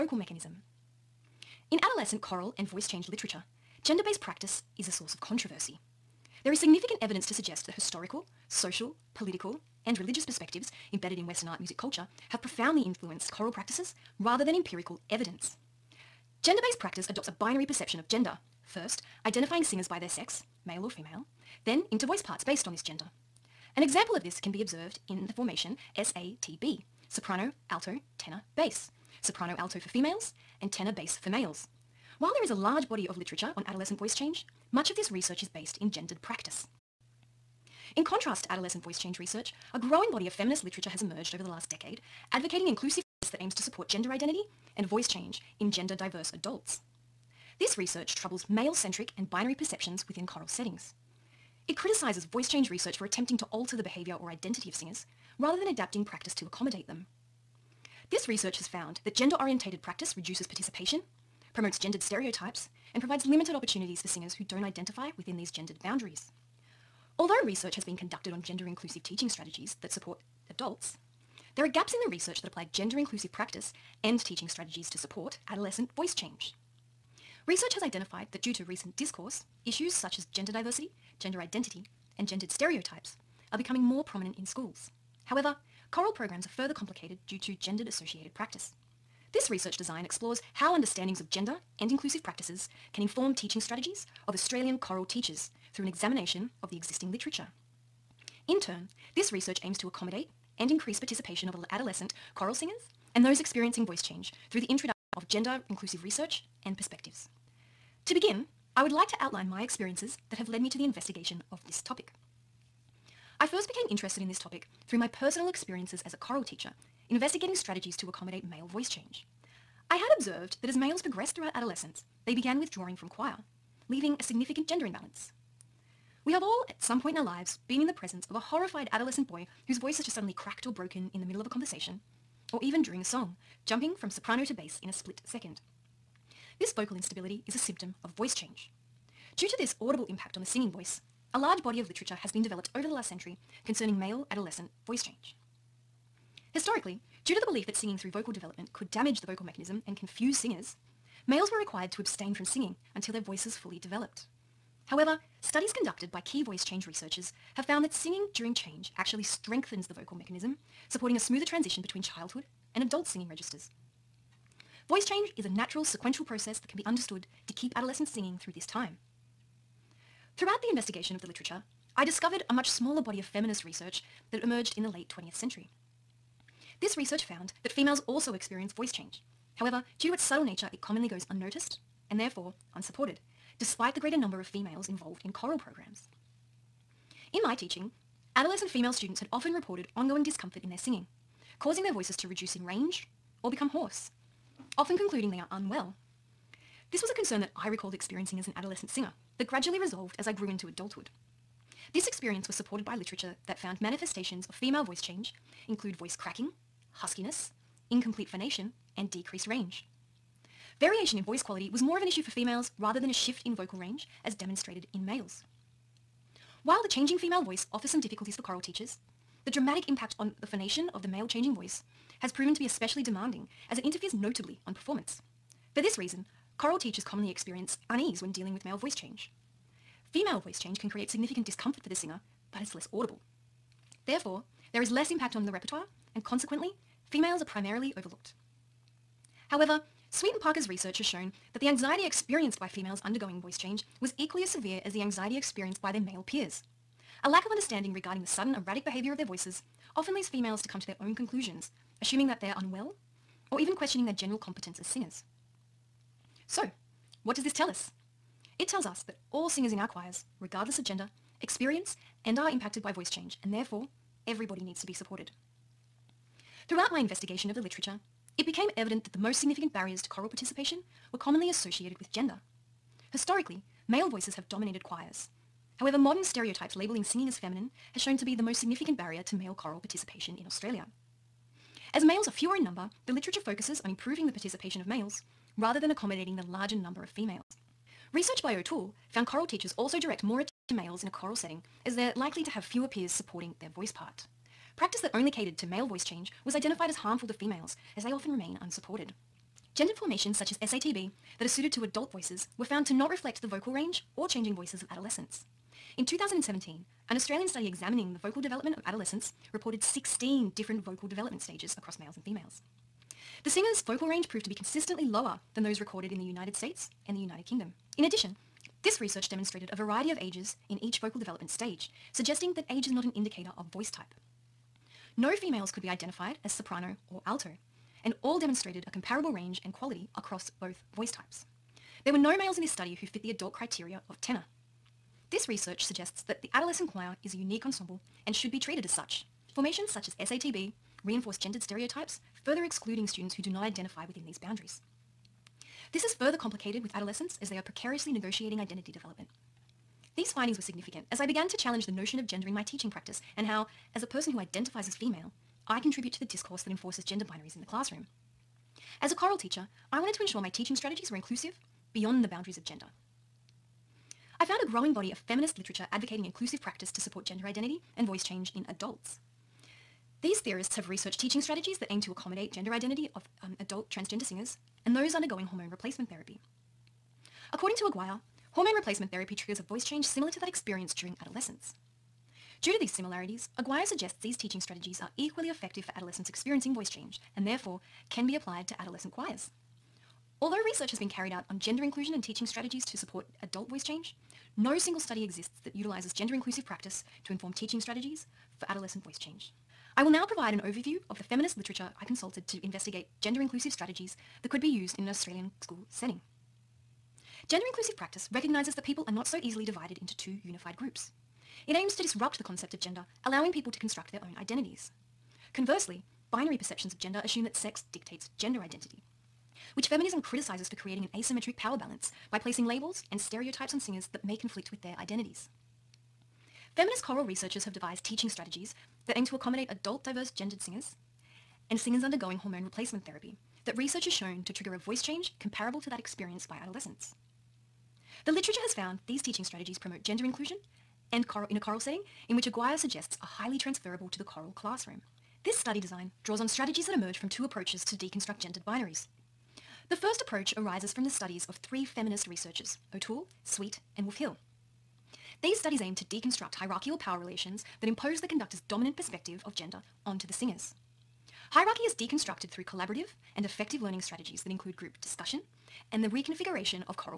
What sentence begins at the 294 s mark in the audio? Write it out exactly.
Practice that only catered to male voice change was identified as harmful to females, as they often remain unsupported.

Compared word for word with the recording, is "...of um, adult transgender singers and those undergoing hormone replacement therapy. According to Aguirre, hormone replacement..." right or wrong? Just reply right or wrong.
right.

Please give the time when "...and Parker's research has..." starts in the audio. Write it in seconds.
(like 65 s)
240 s.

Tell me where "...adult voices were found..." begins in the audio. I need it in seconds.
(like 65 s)
301 s.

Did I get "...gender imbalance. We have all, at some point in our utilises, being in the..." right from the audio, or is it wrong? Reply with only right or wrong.
wrong.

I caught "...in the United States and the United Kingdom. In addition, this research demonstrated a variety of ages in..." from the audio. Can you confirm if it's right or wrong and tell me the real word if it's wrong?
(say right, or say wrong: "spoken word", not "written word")
right.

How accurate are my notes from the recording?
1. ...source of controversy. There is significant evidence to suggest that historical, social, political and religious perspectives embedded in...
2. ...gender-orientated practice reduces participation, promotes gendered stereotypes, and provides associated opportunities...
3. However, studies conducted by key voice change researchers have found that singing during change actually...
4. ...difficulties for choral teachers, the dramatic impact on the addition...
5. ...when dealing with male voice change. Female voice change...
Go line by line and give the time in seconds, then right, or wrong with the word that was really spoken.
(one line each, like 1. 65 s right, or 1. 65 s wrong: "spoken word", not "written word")
1. 4 s right
2. 59 s wrong: "limited", not "associated"
3. 154 s right
4. 218 s wrong: "phonation", not "addition"
5. 228 s right.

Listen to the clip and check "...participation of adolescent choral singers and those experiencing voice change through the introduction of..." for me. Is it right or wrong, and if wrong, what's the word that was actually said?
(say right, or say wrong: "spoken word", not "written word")
right.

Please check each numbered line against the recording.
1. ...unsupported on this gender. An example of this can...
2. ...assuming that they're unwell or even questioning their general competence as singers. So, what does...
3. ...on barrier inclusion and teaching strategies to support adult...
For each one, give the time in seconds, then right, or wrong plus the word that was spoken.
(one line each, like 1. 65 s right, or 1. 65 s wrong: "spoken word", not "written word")
1. 22 s wrong: "based", not "unsupported"
2. 252 s right
3. 391 s wrong: "gender", not "barrier".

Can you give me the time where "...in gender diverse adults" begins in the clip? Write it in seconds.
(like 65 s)
45 s.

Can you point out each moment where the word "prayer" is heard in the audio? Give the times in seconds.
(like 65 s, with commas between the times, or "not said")
not said.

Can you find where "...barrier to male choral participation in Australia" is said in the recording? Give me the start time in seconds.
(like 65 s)
278 s.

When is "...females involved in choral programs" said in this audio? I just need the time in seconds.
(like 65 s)
184 s.